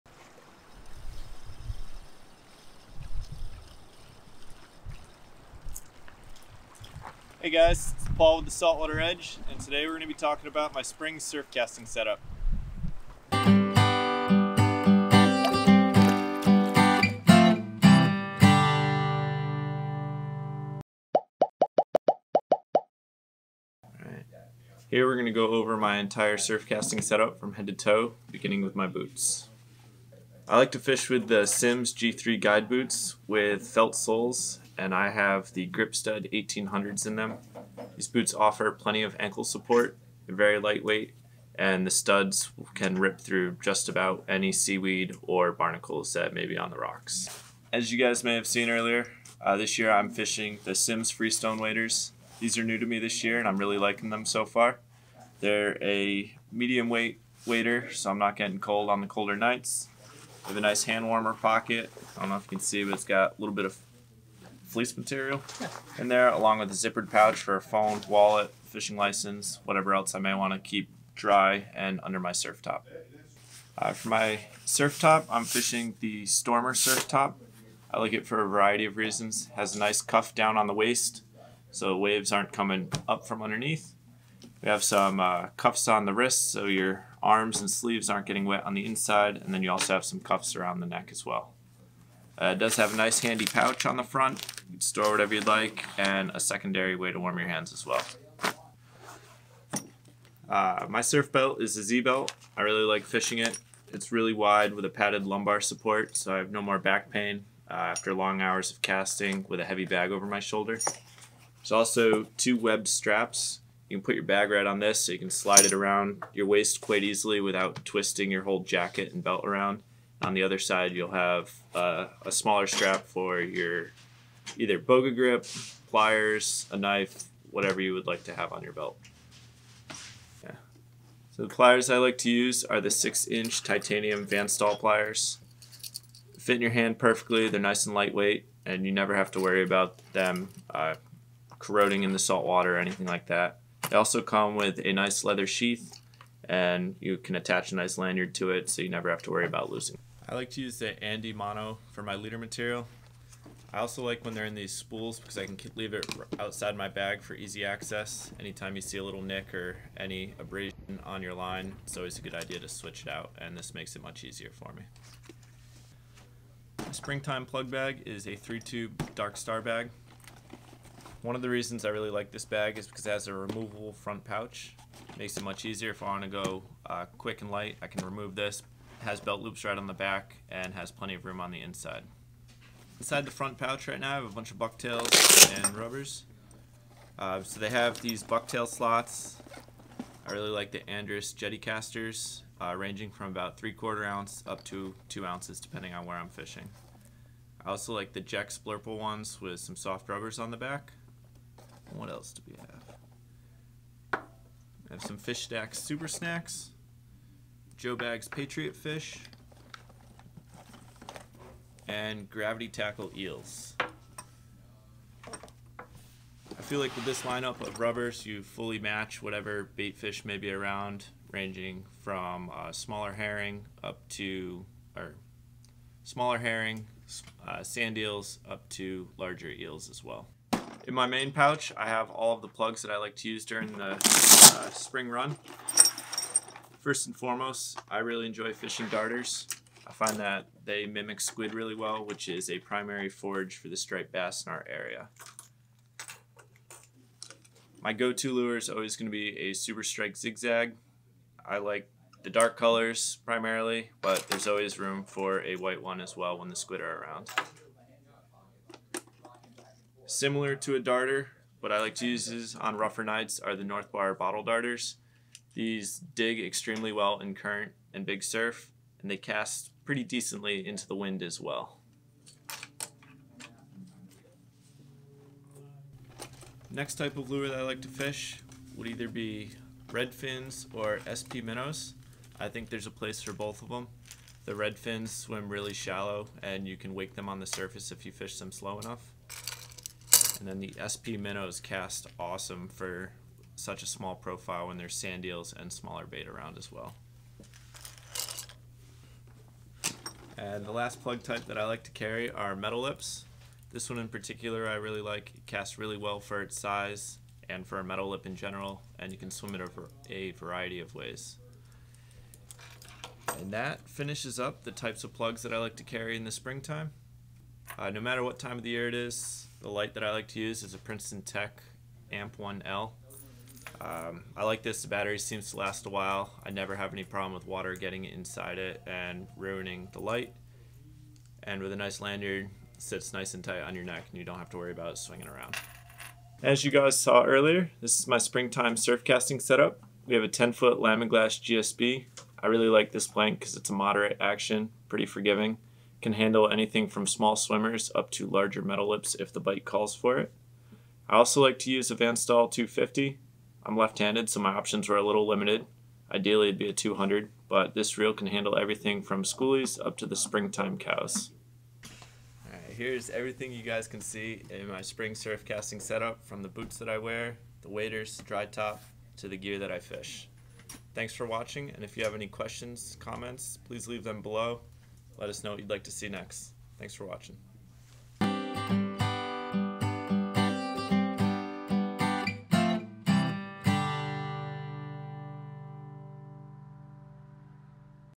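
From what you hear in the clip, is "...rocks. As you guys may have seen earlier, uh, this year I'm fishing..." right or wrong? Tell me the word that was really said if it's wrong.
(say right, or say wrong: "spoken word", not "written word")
right.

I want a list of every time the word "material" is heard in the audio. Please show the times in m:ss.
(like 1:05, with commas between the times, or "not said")
1:04, 2:32.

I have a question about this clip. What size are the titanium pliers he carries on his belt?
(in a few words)
6 inch.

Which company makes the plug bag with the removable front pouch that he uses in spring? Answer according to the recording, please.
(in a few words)
Darkstar.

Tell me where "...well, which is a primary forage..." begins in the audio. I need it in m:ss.
4:01.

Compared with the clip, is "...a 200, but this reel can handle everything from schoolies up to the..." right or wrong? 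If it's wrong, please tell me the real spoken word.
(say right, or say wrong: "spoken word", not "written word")
right.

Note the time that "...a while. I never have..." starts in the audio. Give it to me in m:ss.
5:25.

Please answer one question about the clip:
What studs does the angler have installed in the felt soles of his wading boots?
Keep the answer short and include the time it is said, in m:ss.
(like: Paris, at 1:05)
Grip Stud 1800s, at 0:35.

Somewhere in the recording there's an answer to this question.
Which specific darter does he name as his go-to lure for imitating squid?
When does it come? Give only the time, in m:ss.
4:09.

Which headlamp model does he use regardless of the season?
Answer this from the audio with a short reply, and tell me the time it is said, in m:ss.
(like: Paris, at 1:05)
Princeton Tec Amp 1L, at 5:20.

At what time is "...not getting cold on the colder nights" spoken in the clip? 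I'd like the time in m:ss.
0:58.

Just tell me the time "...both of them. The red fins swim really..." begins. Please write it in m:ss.
4:43.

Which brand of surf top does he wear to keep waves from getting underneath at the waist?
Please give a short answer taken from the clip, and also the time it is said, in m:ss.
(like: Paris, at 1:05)
Stormr, at 1:16.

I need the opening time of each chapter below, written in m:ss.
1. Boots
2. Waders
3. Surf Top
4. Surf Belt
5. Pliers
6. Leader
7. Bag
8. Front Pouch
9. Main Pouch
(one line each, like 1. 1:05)
1. 0:27
2. 0:47
3. 1:13
4. 1:40
5. 2:11
6. 2:30
7. 2:47
8. 3:07
9. 3:52.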